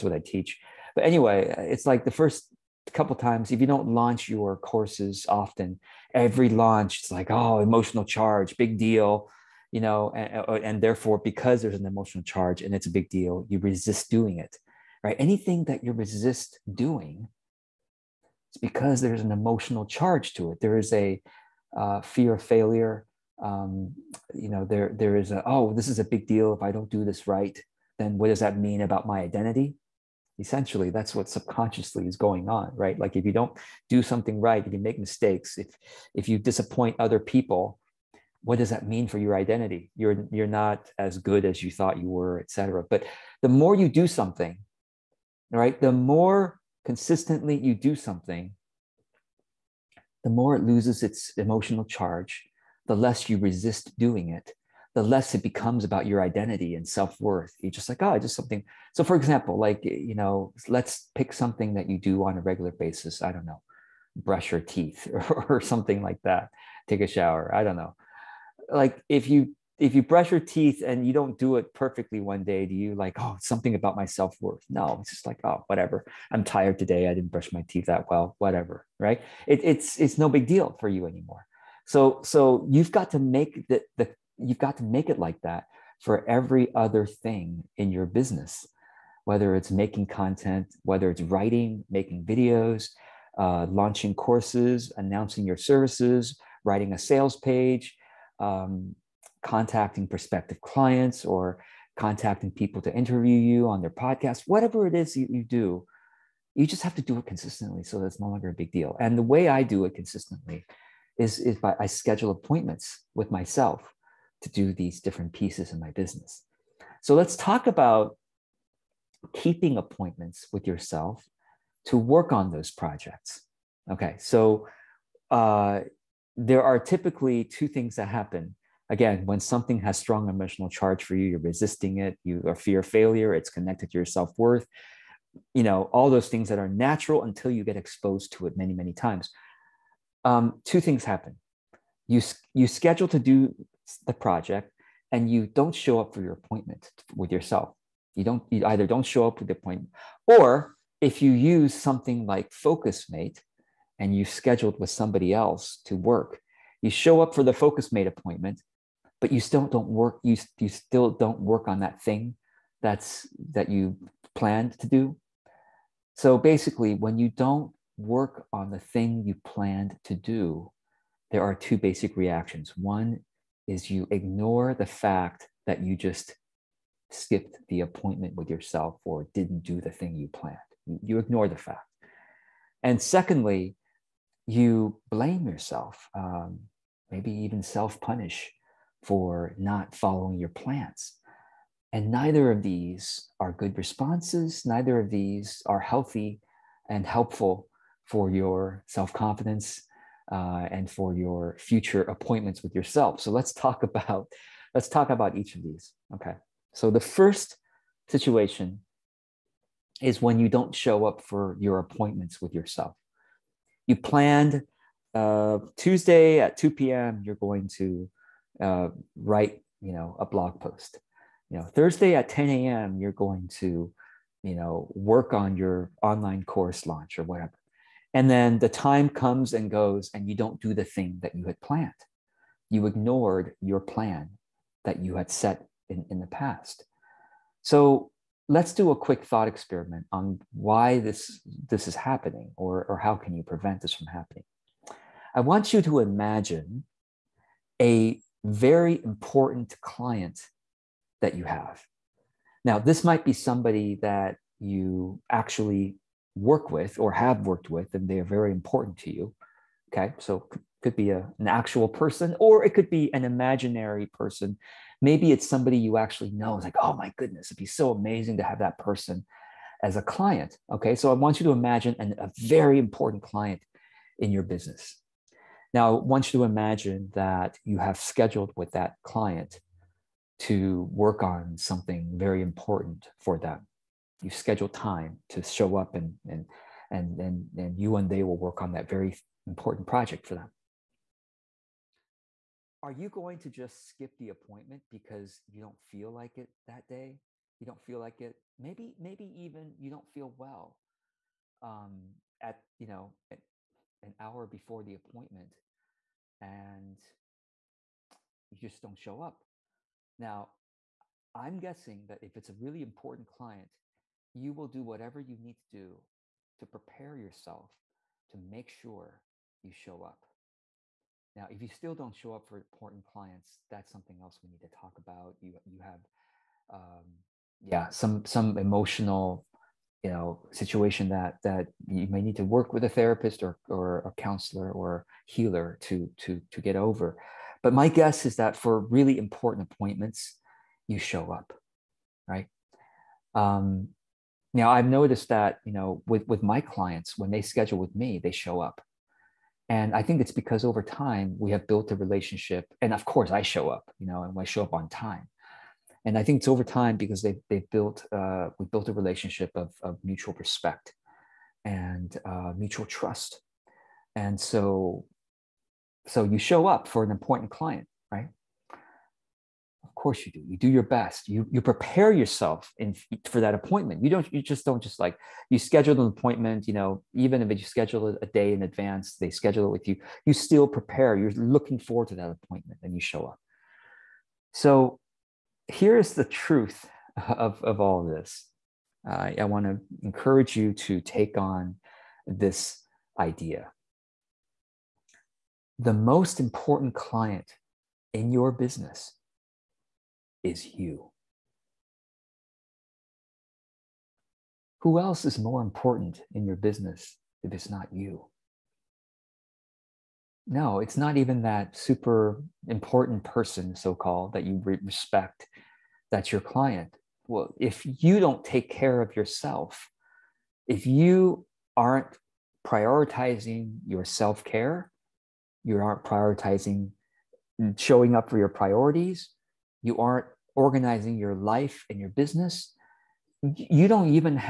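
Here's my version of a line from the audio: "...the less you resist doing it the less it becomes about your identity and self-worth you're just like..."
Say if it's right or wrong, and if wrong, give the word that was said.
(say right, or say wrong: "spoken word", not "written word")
right.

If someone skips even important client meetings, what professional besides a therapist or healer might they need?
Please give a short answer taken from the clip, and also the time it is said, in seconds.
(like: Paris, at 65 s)
Counselor, at 334 s.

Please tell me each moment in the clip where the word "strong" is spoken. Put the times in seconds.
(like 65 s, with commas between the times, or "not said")
129 s.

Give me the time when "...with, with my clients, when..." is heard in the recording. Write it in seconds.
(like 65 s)
346 s.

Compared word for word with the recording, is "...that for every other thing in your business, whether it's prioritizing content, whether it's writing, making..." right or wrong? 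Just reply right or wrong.
wrong.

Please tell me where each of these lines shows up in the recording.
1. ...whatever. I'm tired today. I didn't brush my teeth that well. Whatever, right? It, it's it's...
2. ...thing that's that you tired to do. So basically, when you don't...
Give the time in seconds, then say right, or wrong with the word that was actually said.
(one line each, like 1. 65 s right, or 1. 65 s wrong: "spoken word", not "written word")
1. 75 s right
2. 162 s wrong: "planned", not "tired".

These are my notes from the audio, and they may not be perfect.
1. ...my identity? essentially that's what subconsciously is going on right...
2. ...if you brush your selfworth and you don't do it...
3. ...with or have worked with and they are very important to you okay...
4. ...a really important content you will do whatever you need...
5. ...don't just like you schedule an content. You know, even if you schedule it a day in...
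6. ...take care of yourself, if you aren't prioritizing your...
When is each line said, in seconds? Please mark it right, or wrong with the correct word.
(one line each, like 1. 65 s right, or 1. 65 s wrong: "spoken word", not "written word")
1. 29 s right
2. 69 s wrong: "teeth", not "selfworth"
3. 256 s right
4. 312 s wrong: "client", not "content"
5. 374 s wrong: "appointment", not "content"
6. 418 s right.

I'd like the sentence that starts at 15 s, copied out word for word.
Anything that you resist doing, it's because there's an emotional charge to it.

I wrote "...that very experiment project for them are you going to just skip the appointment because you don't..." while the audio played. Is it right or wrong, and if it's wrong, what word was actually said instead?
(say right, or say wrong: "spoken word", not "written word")
wrong: "important", not "experiment".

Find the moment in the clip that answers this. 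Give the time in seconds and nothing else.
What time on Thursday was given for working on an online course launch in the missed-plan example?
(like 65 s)
222 s.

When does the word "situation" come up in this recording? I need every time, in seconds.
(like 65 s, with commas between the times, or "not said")
208 s, 330 s.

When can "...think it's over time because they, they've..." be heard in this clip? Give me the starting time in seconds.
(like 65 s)
356 s.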